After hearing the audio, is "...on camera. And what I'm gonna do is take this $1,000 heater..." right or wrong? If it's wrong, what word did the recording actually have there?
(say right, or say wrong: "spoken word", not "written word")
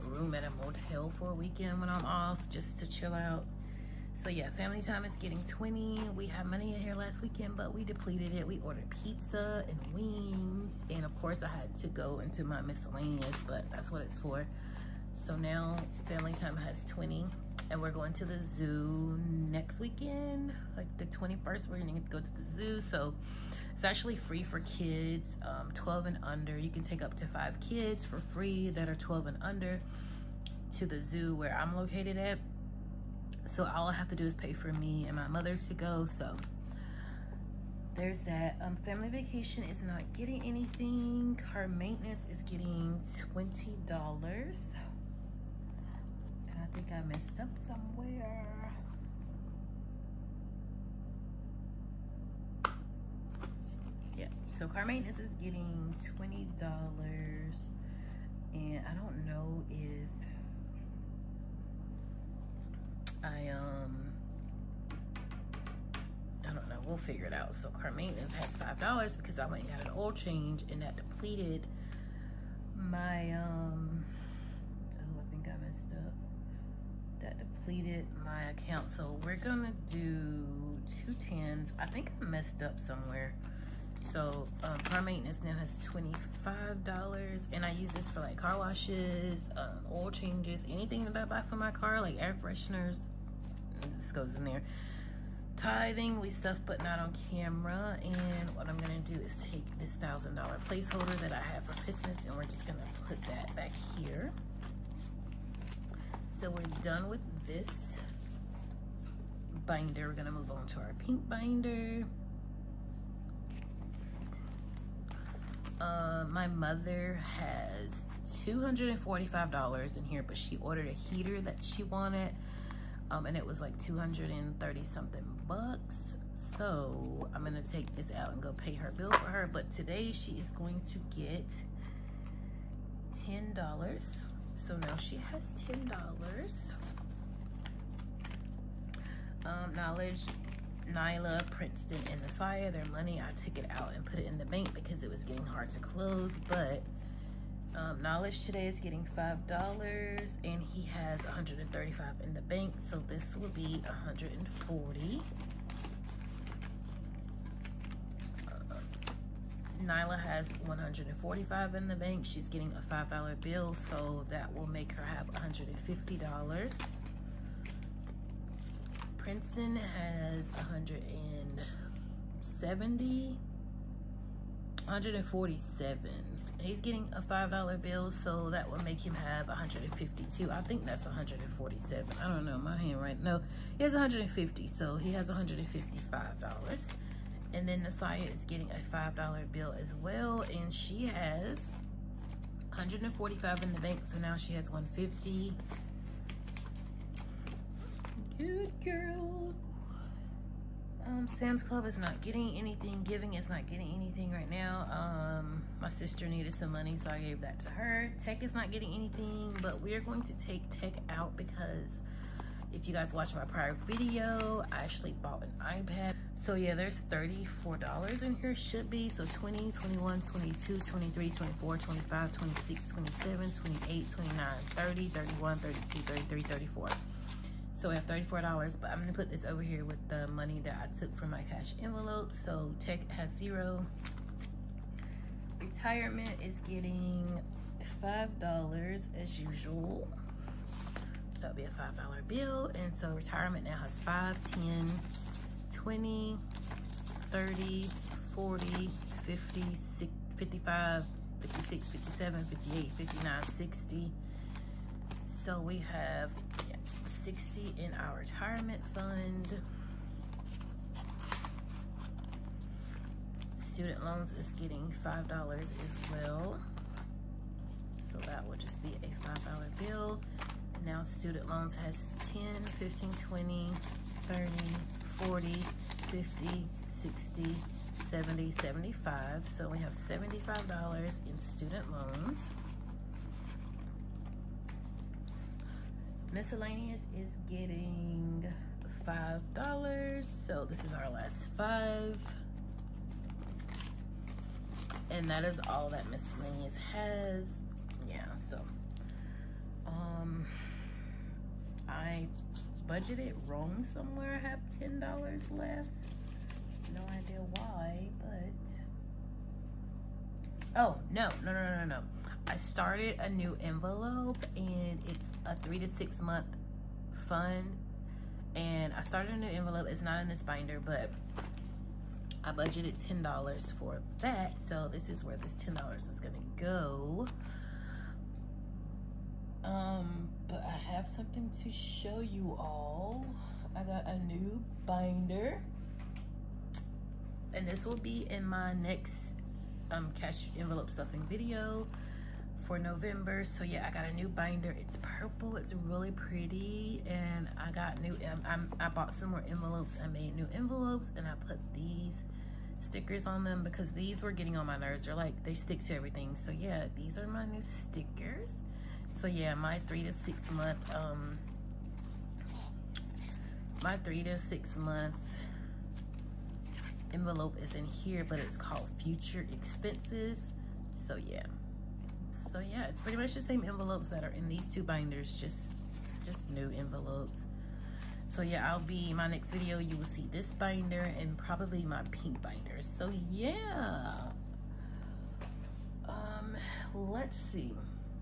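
wrong: "placeholder", not "heater".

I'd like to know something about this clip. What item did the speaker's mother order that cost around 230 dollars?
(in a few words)
a heater.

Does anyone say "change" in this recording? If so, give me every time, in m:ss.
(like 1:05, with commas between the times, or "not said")
1:10, 1:30.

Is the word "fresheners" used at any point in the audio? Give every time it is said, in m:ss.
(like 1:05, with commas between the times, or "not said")
1:32.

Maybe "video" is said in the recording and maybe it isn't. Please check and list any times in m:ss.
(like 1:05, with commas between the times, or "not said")
3:33, 5:41, 6:19.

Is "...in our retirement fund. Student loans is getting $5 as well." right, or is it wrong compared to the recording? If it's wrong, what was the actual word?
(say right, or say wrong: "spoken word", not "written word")
right.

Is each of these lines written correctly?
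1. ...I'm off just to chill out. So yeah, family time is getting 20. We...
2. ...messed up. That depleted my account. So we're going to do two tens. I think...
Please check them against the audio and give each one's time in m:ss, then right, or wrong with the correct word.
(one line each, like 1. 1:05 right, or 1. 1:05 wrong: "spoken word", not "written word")
1. 0:01 right
2. 1:15 right.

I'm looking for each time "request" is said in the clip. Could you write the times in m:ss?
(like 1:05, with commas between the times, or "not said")
not said.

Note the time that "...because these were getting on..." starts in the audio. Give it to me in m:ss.
5:53.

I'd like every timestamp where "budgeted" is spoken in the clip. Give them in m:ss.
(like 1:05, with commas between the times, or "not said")
5:02, 5:22.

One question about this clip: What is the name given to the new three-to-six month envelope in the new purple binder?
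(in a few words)
future expenses.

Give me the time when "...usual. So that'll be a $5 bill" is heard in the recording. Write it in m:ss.
3:59.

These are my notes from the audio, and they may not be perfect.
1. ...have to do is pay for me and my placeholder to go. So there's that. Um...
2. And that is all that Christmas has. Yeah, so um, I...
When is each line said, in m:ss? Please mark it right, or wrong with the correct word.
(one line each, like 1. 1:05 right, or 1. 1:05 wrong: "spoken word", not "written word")
1. 0:33 wrong: "mother", not "placeholder"
2. 4:55 wrong: "Miscellaneous", not "Christmas".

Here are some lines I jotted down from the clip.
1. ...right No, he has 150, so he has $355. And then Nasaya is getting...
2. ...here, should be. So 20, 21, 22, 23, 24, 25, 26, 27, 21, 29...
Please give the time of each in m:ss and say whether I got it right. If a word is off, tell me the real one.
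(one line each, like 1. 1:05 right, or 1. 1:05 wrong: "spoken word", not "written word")
1. 3:03 wrong: "155", not "355"
2. 3:38 wrong: "28", not "21".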